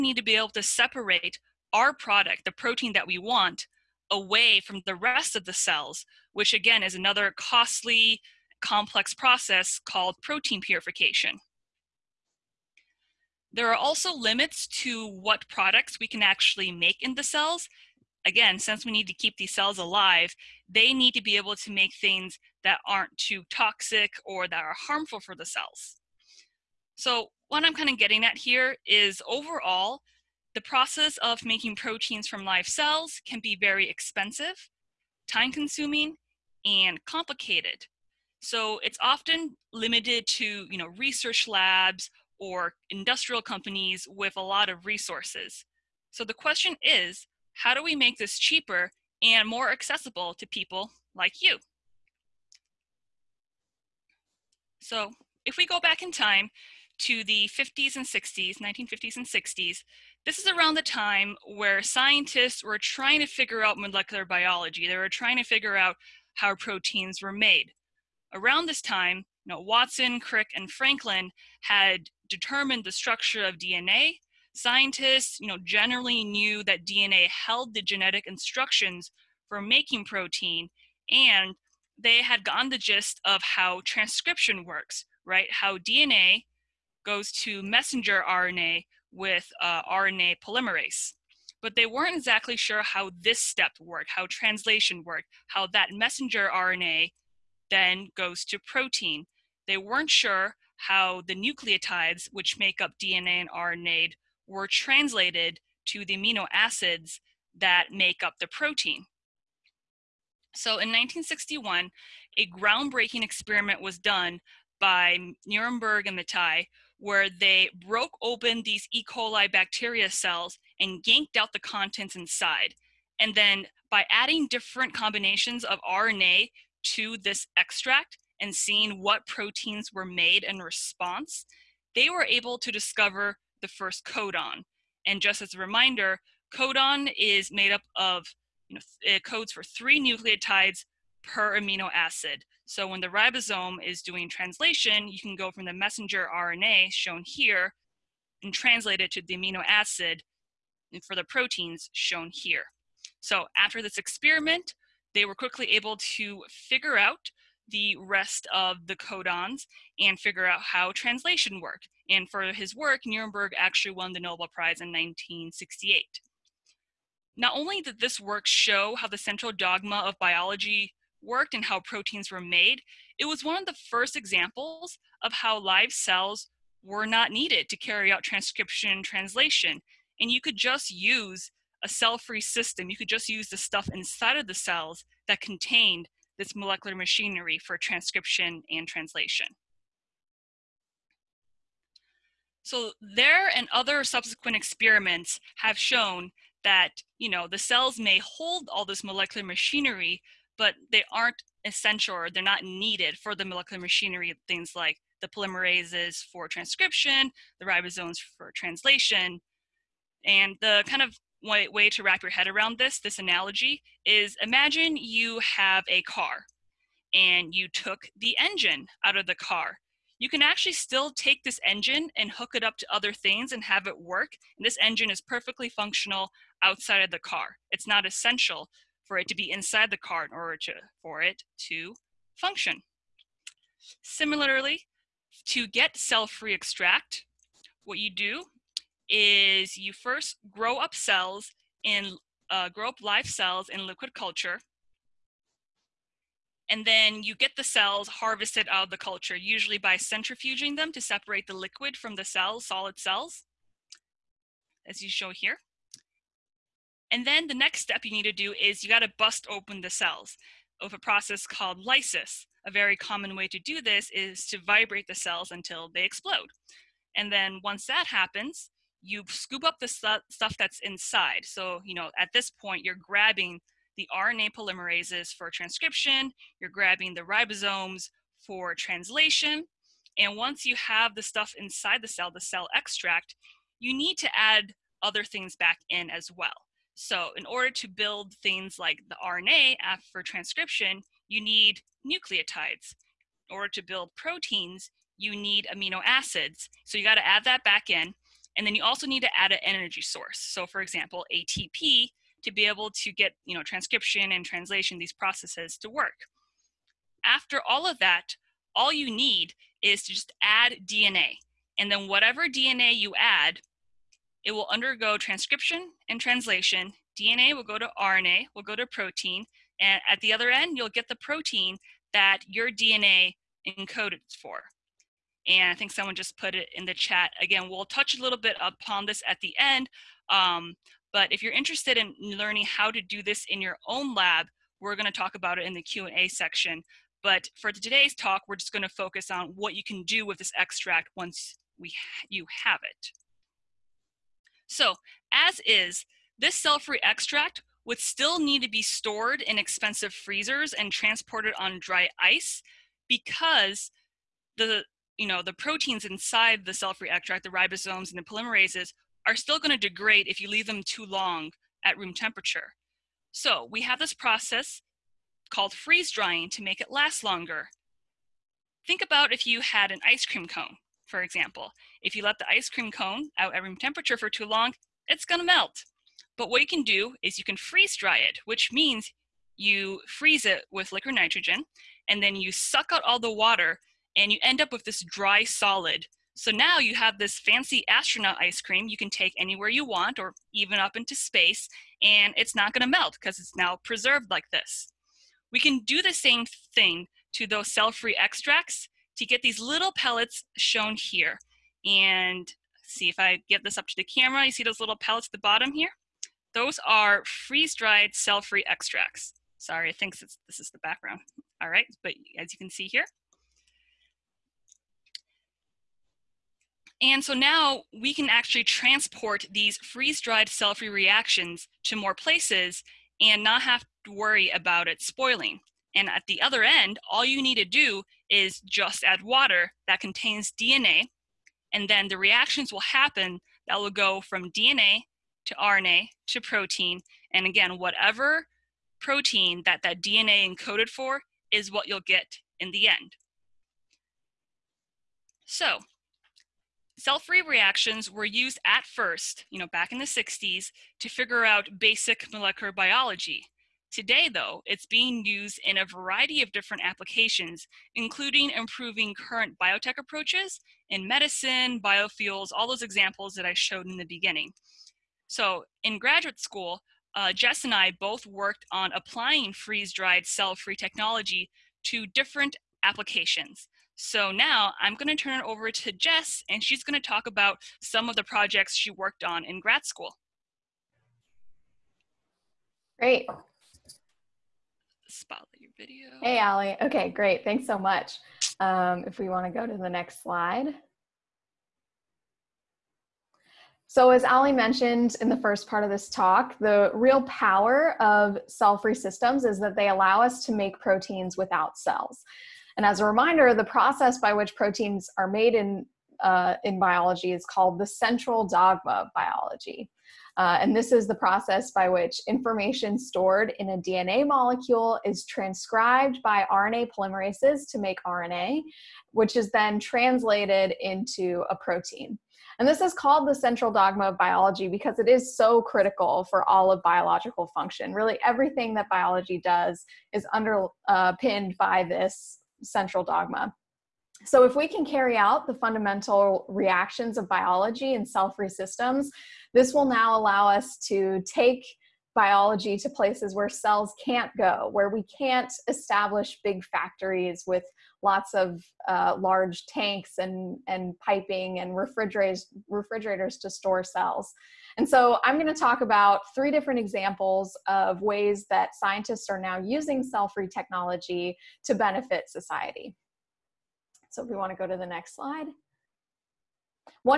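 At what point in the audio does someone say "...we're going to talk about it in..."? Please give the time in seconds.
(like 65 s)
334 s.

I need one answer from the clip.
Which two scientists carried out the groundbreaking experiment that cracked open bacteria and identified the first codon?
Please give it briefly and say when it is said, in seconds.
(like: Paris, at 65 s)
Nirenberg and Matthaei, at 115 s.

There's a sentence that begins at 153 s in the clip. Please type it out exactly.
So after this experiment, they were quickly able to figure out the rest of the codons and figure out how translation worked.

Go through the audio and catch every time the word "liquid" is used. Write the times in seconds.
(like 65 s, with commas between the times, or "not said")
243 s, 251 s, 380 s.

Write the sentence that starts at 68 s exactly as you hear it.
Around this time, you know, Watson, Crick, and Franklin had determined the structure of DNA.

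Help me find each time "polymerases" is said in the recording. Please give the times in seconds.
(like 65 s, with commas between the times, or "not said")
90 s, 205 s, 274 s, 358 s, 516 s.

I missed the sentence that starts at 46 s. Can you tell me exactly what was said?
So the question is how do we make this cheaper and more accessible to people like you?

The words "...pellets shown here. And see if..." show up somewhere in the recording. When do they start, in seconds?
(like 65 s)
399 s.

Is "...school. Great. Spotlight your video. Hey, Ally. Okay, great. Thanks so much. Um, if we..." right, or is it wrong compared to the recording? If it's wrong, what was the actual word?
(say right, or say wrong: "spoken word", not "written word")
right.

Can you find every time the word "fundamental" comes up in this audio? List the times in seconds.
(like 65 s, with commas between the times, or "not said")
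535 s.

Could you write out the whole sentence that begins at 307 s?
After all of that, all you need is to just add DNA.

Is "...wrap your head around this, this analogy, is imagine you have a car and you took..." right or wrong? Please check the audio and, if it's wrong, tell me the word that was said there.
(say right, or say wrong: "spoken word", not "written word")
right.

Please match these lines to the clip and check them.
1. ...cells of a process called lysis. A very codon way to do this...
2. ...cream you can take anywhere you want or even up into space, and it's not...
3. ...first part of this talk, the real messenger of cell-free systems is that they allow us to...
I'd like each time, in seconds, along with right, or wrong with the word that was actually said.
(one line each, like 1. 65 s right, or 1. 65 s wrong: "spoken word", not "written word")
1. 259 s wrong: "common", not "codon"
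2. 388 s right
3. 495 s wrong: "power", not "messenger".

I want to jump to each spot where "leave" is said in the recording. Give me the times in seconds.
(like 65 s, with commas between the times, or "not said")
360 s.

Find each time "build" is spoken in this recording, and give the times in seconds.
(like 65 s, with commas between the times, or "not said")
287 s, 293 s.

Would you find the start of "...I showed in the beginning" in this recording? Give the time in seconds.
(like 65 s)
463 s.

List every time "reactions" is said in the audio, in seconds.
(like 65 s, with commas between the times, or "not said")
420 s, 432 s, 447 s, 536 s.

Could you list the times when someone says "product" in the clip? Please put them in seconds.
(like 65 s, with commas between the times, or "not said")
1 s, 15 s.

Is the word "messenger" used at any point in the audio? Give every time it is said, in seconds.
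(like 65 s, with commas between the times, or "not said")
87 s, 95 s, 145 s.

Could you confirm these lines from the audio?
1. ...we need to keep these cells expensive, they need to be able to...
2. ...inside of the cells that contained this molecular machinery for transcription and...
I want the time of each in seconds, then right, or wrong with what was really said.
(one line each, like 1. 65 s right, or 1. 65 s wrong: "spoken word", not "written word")
1. 18 s wrong: "alive", not "expensive"
2. 183 s right.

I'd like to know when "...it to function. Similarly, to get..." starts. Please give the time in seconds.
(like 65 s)
231 s.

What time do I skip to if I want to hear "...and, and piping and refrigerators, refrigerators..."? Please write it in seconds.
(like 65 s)
550 s.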